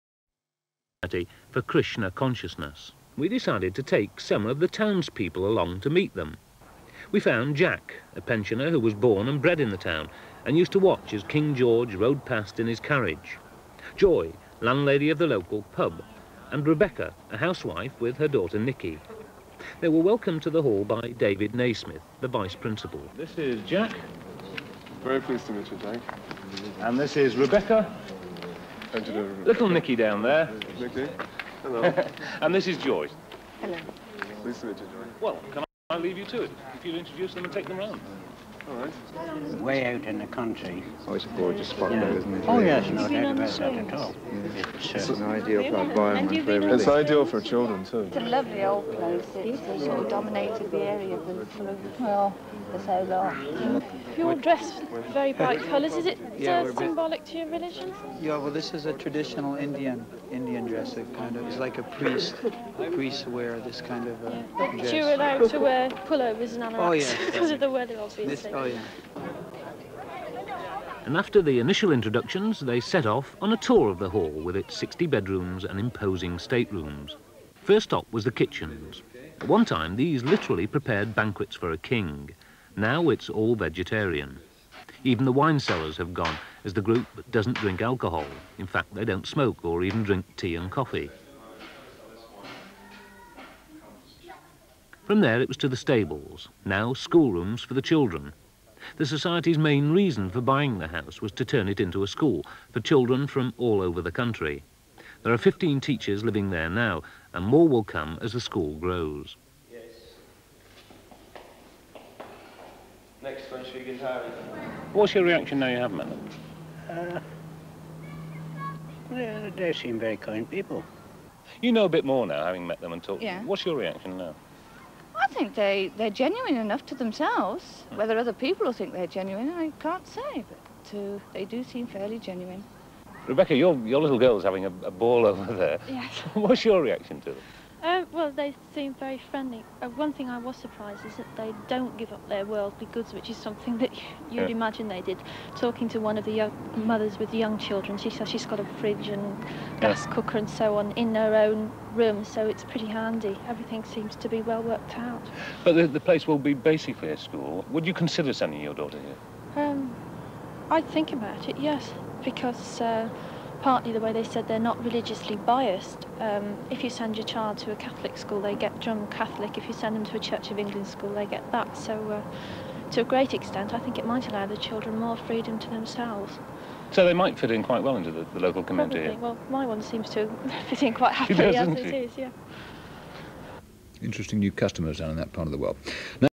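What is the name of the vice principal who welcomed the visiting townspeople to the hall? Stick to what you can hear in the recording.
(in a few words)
David Naismith.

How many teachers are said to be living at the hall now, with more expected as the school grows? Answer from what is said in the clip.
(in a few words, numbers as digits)
15.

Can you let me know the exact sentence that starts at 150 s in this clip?
cooker and so on in her own room, so it's pretty handy.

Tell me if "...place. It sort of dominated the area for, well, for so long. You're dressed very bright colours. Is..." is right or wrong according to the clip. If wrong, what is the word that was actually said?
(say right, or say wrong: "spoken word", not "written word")
right.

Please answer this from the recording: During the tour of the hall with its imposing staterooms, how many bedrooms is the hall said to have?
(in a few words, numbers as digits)
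60.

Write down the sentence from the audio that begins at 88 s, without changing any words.
In fact, they don't smoke or even drink tea and coffee.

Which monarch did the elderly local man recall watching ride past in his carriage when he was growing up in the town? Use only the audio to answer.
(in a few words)
King George.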